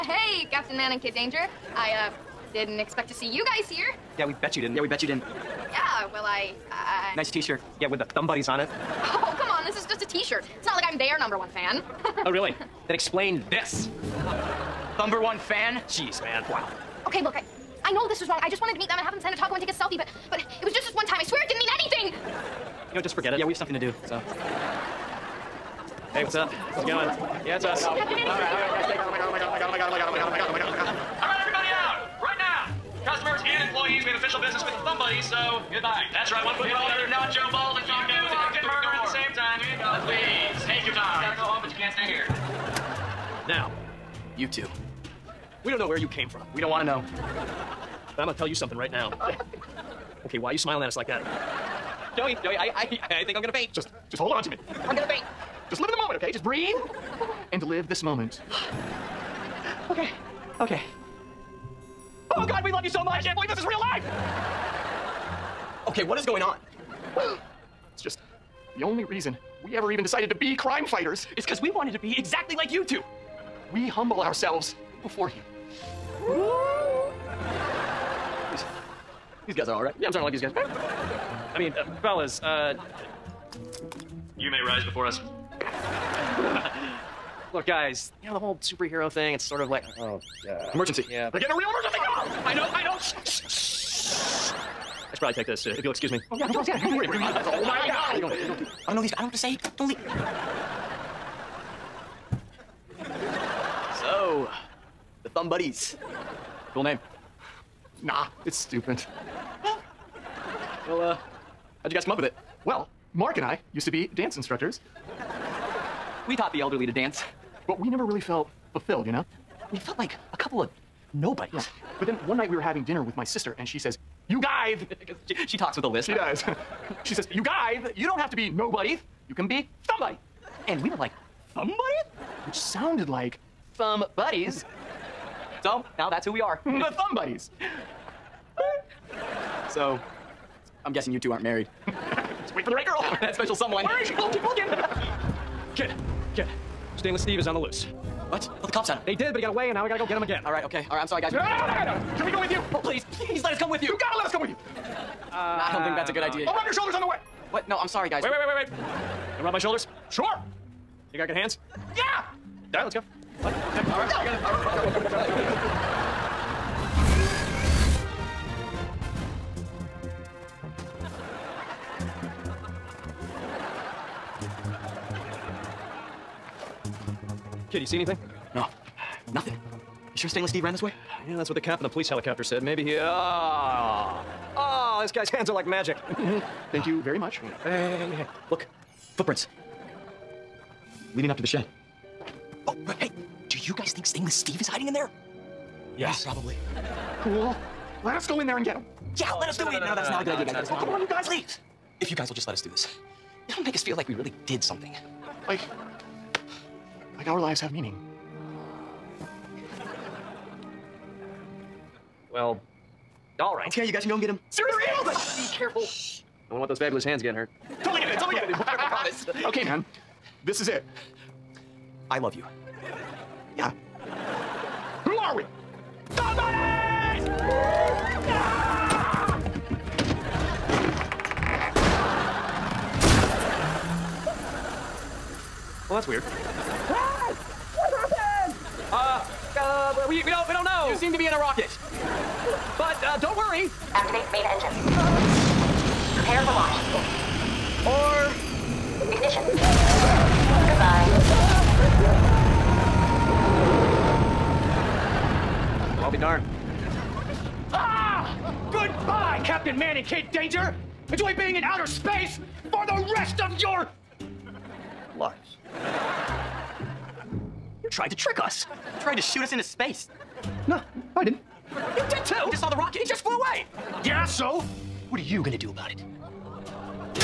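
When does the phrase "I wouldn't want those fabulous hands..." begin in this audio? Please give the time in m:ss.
3:35.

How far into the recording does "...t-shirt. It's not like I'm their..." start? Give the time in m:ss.
0:10.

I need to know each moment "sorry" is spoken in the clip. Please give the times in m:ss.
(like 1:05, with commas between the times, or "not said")
2:31, 2:37.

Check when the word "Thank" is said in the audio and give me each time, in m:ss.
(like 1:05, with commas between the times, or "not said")
3:06.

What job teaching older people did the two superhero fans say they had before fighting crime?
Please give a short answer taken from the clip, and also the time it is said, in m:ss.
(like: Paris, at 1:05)
Dance instructors, at 1:54.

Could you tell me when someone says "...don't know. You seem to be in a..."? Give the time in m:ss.
4:00.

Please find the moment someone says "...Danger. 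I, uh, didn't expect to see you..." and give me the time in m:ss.
0:01.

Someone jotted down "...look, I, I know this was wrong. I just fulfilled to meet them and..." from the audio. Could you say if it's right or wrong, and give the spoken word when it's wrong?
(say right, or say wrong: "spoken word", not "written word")
wrong: "wanted", not "fulfilled".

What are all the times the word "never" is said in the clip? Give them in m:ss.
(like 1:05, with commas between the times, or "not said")
1:57.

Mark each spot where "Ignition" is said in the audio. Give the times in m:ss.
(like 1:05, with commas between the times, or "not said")
4:09.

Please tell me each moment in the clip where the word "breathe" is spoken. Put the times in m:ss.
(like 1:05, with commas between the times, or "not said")
0:56.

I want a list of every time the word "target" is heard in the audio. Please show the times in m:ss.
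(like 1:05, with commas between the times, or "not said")
not said.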